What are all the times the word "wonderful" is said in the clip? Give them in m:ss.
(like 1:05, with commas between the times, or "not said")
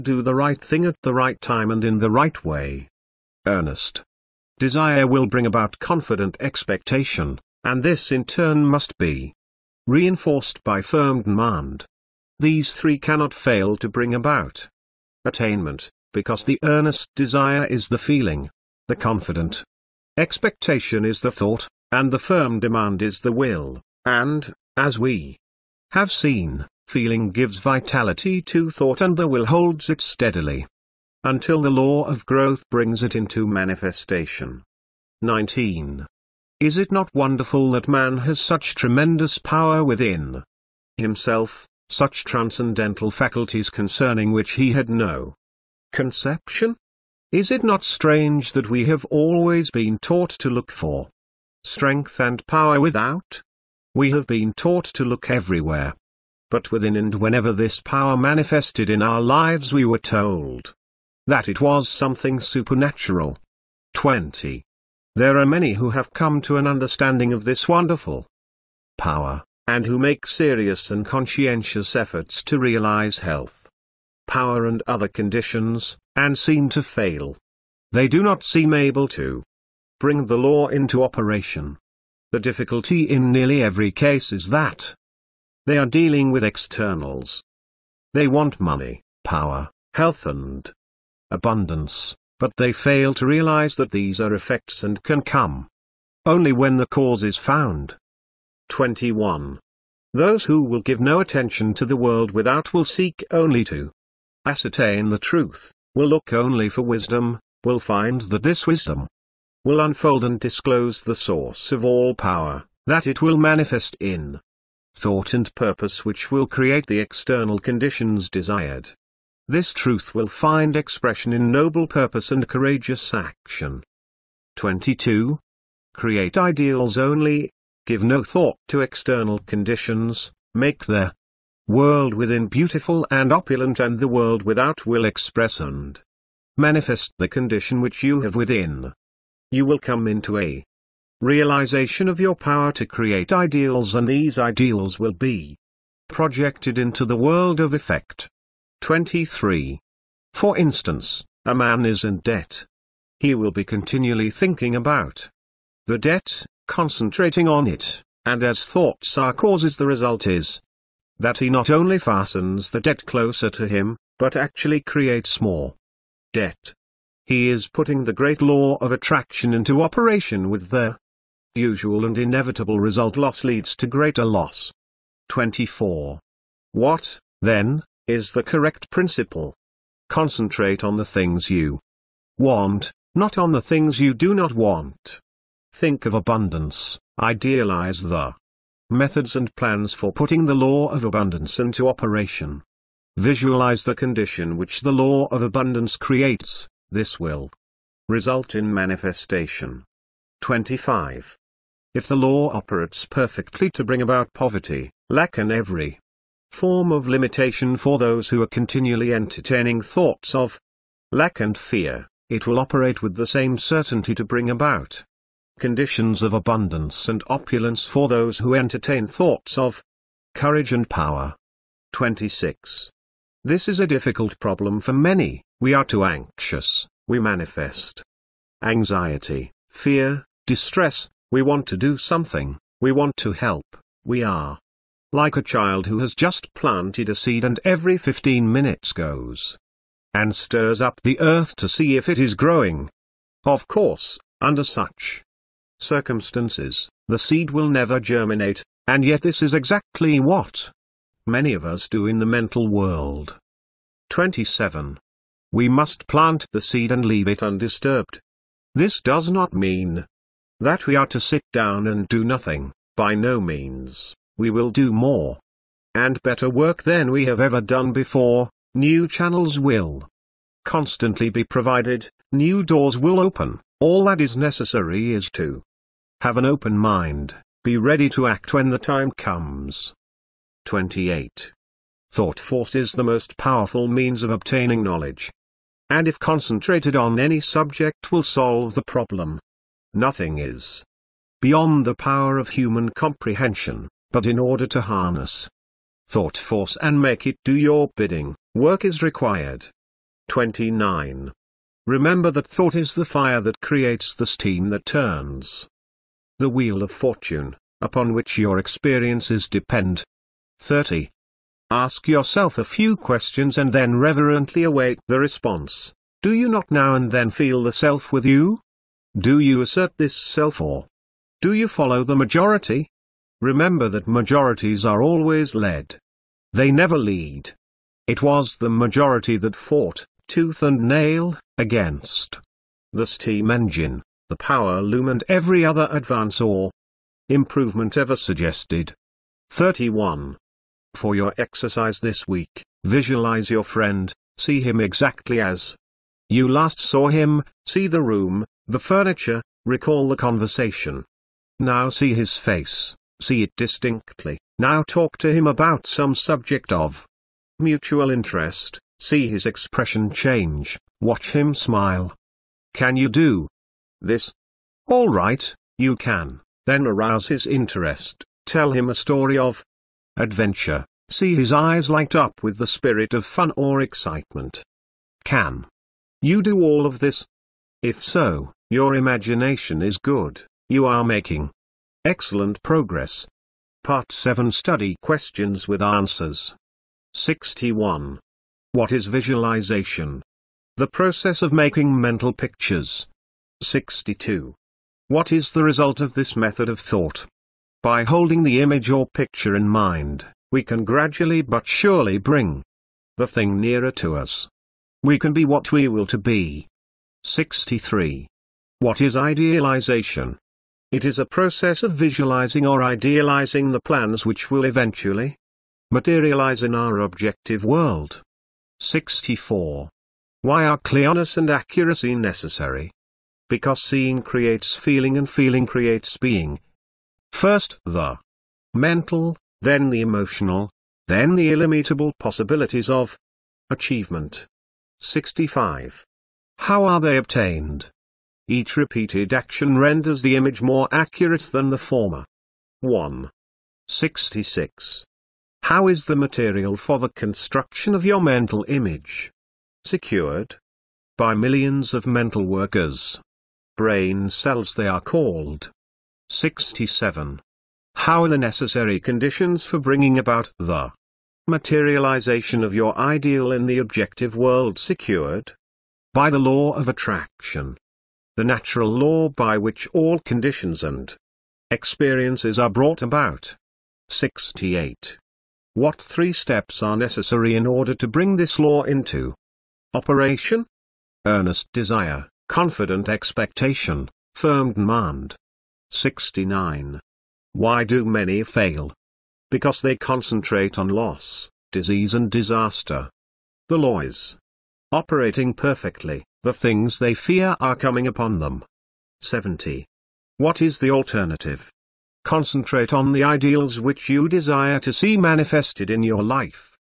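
0:37, 1:07.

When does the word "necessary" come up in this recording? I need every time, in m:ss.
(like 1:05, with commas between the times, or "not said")
4:34, 7:02, 7:38, 7:56.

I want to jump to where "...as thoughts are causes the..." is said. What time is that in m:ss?
2:38.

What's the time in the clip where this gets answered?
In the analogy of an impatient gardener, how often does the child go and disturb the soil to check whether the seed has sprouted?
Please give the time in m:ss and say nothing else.
3:57.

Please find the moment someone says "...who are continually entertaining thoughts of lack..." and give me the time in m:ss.
3:28.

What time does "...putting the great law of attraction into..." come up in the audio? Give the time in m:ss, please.
2:47.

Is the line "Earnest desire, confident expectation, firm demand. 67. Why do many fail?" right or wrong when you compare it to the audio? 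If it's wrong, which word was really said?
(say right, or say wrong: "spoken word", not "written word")
wrong: "69", not "67".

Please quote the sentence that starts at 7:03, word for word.
Because seeing creates feeling and feeling creates being.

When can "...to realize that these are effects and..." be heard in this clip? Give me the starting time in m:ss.
1:33.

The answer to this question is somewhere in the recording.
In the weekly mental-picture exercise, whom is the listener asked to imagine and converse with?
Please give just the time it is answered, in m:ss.
5:43.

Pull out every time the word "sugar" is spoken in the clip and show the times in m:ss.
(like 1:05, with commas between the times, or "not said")
not said.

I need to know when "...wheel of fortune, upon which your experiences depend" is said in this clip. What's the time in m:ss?
5:06.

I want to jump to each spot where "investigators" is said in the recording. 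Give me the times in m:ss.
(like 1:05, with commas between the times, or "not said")
not said.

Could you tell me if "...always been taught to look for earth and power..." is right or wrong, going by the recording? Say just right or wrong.
wrong.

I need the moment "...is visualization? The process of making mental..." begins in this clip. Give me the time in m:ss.
6:28.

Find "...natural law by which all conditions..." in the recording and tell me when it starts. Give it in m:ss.
7:48.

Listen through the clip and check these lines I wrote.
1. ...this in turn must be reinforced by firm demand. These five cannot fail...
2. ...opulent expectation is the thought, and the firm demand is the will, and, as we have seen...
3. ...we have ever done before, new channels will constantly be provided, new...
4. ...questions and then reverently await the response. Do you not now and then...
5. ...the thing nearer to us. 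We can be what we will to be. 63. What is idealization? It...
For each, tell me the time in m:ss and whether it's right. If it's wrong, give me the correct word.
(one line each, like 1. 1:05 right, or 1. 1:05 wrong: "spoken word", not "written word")
1. 0:07 wrong: "three", not "five"
2. 0:18 wrong: "confident", not "opulent"
3. 4:27 right
4. 5:12 right
5. 6:43 right.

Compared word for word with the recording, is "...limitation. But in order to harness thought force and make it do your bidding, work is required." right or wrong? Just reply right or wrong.
wrong.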